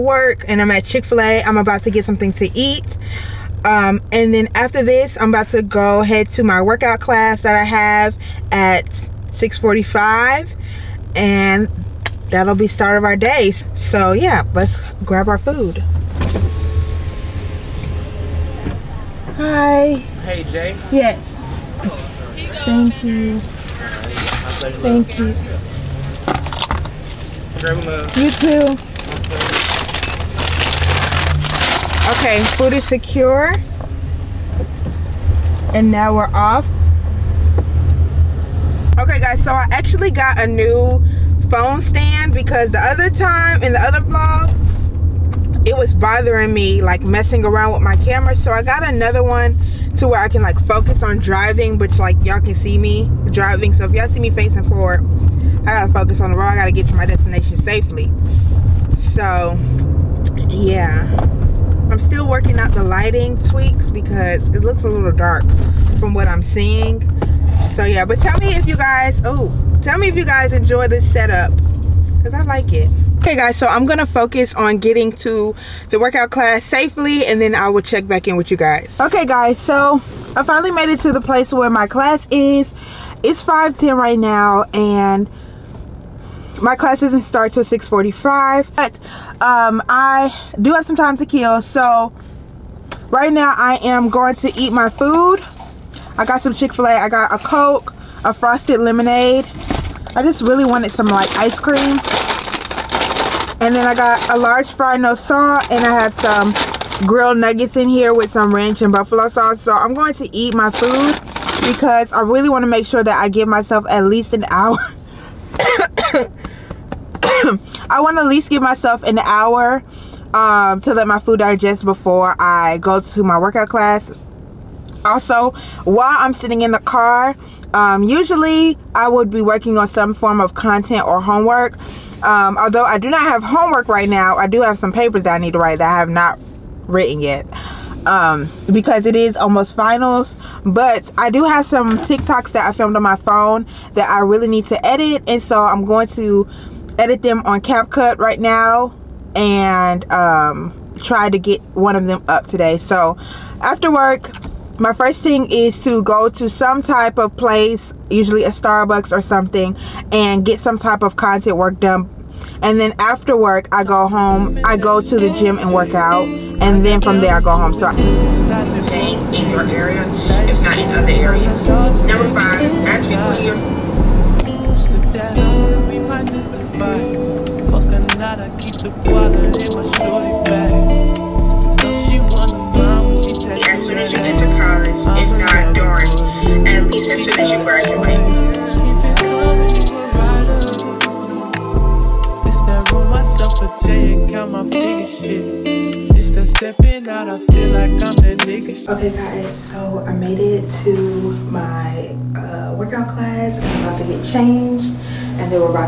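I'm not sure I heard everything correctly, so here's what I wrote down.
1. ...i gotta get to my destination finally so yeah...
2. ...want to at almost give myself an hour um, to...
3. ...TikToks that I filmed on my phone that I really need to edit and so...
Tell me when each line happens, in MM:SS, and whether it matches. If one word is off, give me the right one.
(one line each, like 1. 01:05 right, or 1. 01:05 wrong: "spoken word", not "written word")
1. 00:56 wrong: "safely", not "finally"
2. 01:57 wrong: "least", not "almost"
3. 02:21 right.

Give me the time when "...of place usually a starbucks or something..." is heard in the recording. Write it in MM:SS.
02:37.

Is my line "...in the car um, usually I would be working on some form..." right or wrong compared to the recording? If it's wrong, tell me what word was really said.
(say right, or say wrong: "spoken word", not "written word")
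right.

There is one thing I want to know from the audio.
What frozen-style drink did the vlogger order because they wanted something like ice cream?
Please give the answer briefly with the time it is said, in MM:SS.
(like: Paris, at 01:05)
Frosted lemonade, at 01:38.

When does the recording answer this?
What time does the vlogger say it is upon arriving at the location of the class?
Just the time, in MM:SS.
01:23.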